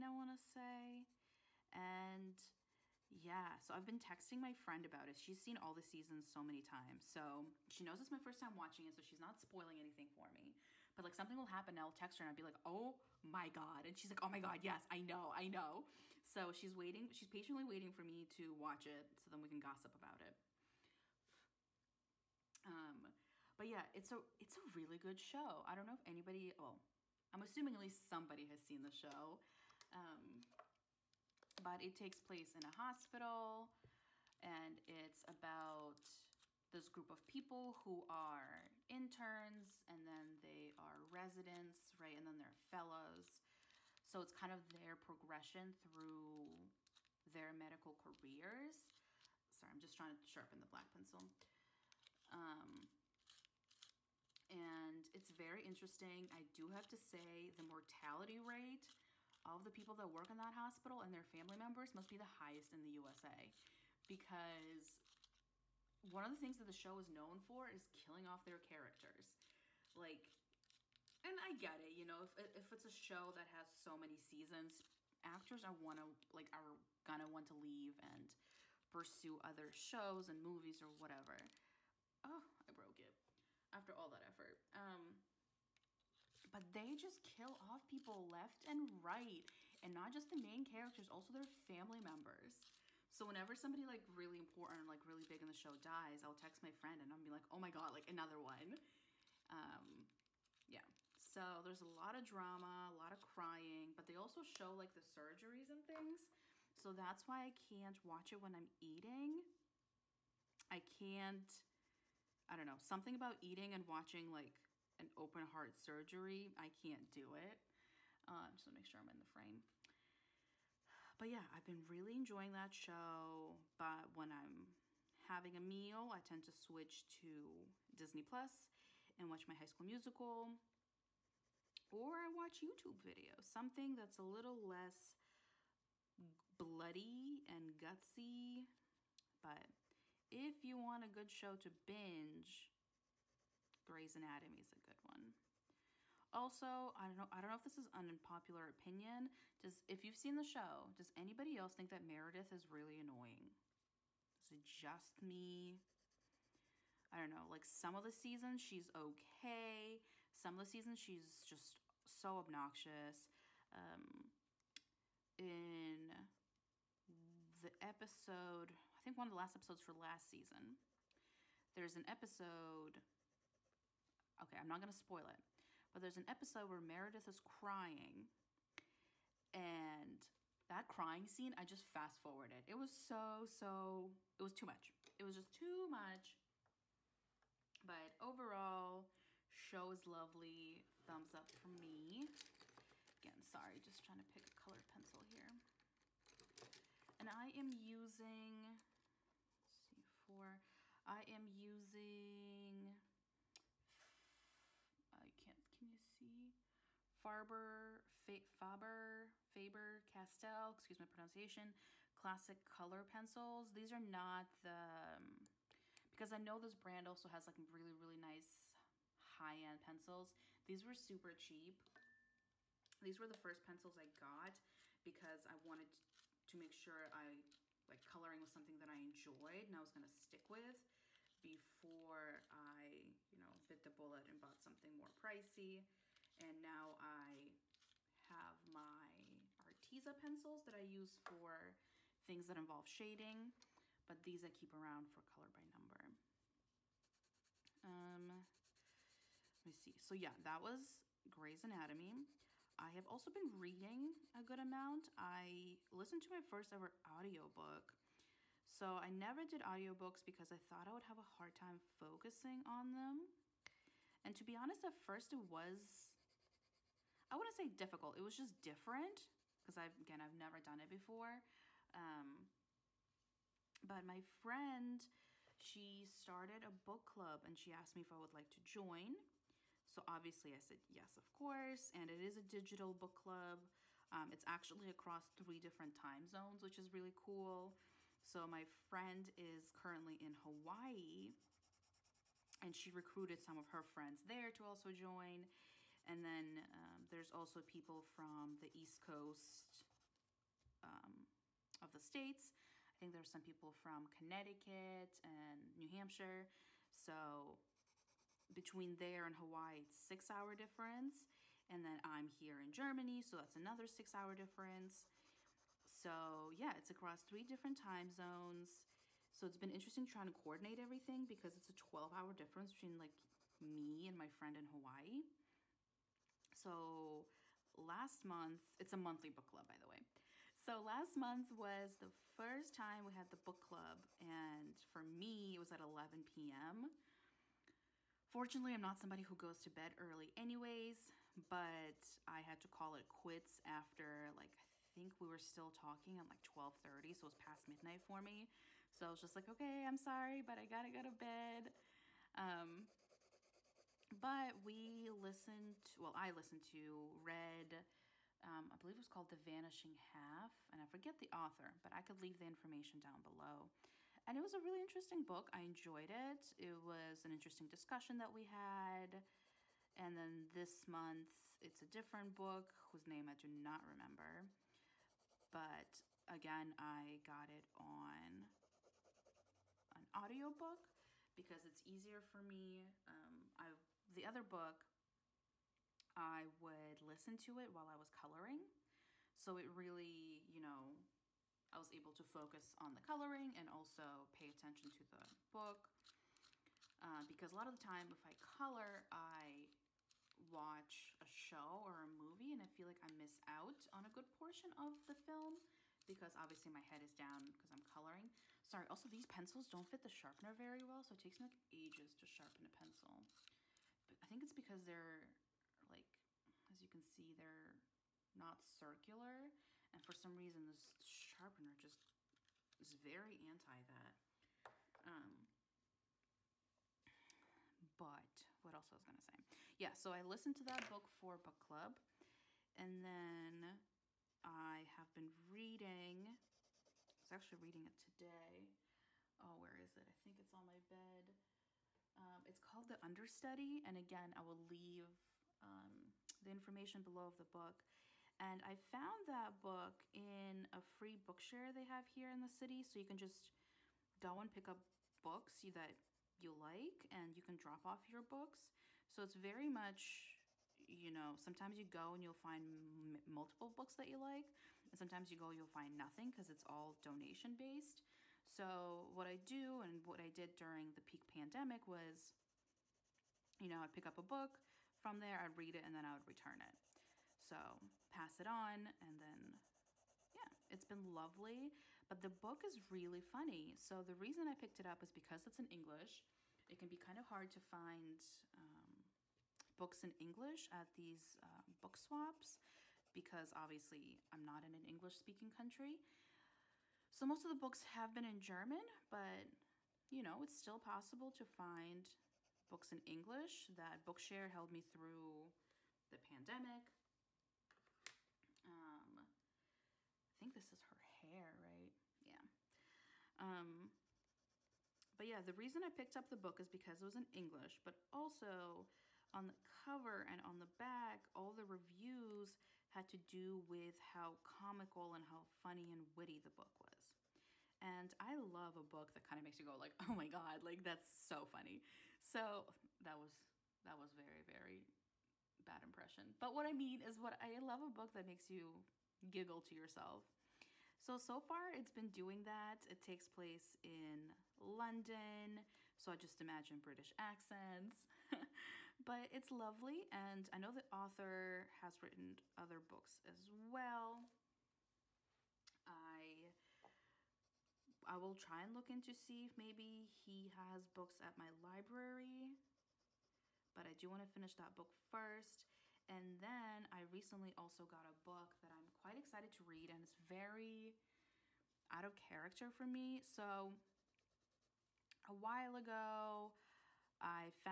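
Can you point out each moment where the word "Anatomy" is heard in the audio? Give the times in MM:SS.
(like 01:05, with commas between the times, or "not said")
02:24, 04:11.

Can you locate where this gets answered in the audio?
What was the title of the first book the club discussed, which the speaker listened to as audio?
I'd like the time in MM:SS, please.
05:59.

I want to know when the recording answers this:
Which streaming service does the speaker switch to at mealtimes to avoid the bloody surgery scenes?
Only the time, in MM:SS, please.
02:07.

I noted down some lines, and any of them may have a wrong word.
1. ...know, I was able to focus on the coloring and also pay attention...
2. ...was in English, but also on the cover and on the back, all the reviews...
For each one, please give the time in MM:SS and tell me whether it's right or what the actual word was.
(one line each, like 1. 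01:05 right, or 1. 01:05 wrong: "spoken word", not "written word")
1. 06:30 right
2. 08:37 right.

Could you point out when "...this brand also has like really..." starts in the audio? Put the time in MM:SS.
03:36.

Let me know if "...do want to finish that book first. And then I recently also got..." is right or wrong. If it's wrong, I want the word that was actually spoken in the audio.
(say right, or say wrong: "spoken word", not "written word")
right.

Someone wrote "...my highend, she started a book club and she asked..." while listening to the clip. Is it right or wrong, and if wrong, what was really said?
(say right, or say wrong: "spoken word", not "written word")
wrong: "friend", not "highend".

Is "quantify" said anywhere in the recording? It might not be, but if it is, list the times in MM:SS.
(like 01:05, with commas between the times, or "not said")
not said.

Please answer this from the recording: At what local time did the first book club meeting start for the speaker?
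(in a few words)
11 p.m.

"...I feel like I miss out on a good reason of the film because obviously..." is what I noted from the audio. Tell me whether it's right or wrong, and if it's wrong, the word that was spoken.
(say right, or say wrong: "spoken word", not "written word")
wrong: "portion", not "reason".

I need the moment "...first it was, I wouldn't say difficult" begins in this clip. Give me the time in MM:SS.
04:24.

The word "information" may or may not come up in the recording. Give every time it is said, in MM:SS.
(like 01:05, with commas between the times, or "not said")
06:02, 07:26.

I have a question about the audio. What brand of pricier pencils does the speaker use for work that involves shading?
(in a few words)
Arteza.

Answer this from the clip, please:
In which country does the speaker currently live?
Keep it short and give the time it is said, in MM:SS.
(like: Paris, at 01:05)
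Germany, at 05:12.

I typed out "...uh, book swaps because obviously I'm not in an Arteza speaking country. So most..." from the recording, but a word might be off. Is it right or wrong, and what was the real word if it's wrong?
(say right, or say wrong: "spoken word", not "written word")
wrong: "English", not "Arteza".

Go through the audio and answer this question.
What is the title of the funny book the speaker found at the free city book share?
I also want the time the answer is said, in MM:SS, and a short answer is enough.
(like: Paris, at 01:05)
The Understudy, at 07:22.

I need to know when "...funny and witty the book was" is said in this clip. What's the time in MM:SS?
08:45.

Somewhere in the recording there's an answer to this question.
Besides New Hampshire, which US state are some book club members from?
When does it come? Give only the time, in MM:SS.
05:04.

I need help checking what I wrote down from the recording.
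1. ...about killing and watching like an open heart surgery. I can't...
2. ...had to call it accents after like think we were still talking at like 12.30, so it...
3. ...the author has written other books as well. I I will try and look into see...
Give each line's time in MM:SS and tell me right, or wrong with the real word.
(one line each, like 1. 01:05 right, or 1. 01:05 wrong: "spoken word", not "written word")
1. 01:53 wrong: "eating", not "killing"
2. 05:42 wrong: "quits", not "accents"
3. 09:10 right.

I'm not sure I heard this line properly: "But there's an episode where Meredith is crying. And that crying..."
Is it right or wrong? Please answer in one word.
right.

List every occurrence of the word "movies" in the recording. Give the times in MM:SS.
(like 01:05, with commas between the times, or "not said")
01:20, 06:42.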